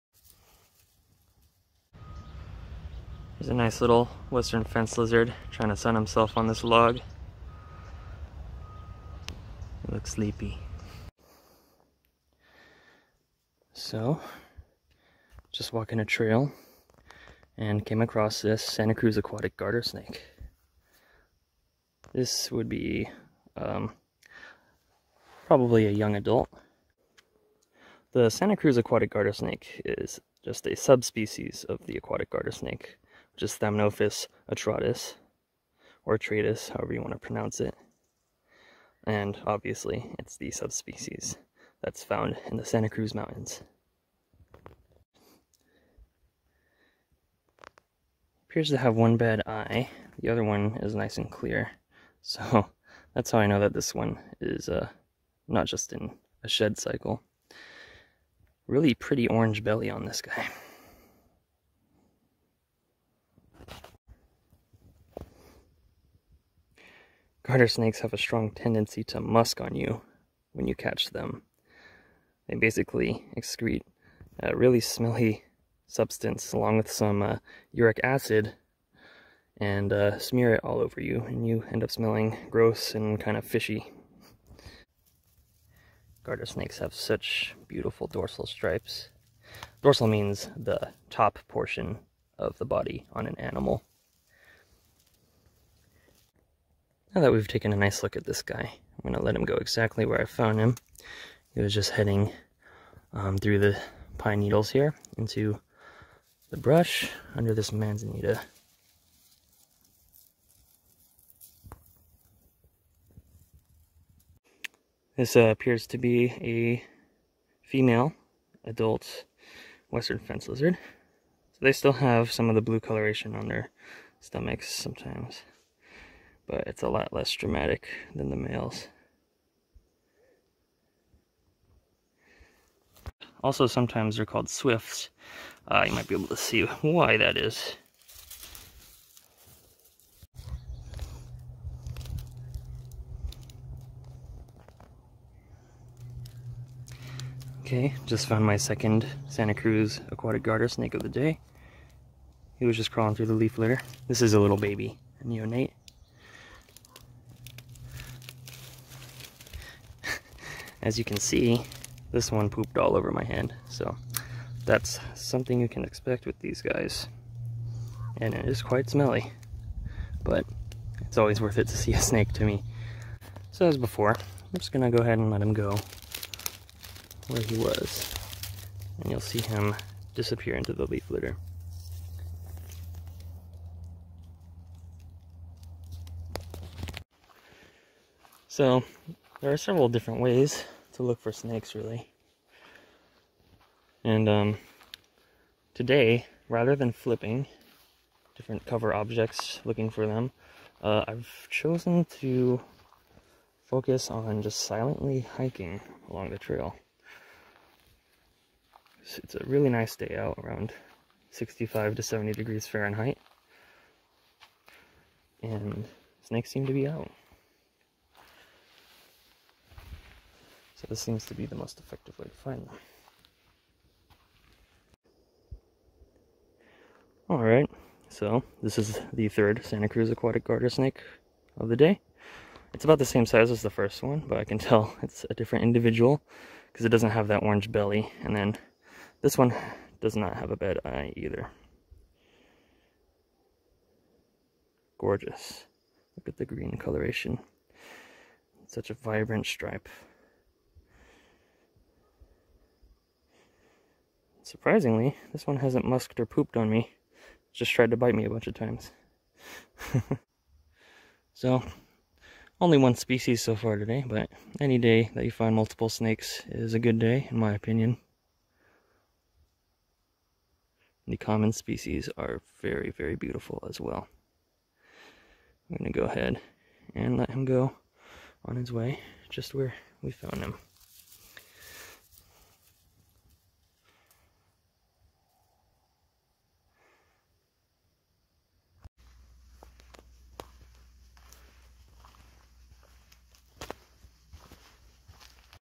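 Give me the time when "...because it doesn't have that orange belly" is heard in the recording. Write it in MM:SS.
03:56.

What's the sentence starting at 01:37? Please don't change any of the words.
Now that we've taken a nice look at this guy, I'm going to let him go exactly where I found him.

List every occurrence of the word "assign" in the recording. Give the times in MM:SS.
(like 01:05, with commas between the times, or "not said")
not said.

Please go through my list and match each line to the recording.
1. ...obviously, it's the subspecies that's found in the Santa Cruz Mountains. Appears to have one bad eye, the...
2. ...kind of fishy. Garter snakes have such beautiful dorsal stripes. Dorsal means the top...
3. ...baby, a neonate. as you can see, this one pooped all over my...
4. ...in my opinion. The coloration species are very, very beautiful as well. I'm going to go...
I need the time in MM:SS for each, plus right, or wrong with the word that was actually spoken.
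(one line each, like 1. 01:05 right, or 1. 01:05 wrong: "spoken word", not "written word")
1. 00:39 right
2. 01:23 right
3. 02:34 right
4. 04:27 wrong: "common", not "coloration".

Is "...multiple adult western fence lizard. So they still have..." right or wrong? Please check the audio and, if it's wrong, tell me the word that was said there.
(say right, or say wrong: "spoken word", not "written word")
wrong: "female", not "multiple".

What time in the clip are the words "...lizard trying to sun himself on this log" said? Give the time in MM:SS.
00:04.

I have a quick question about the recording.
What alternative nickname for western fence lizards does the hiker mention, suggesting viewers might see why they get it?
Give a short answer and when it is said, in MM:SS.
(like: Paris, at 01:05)
swifts, at 02:14.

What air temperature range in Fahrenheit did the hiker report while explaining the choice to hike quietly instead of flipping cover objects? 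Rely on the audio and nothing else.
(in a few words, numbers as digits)
65 to 70 degrees.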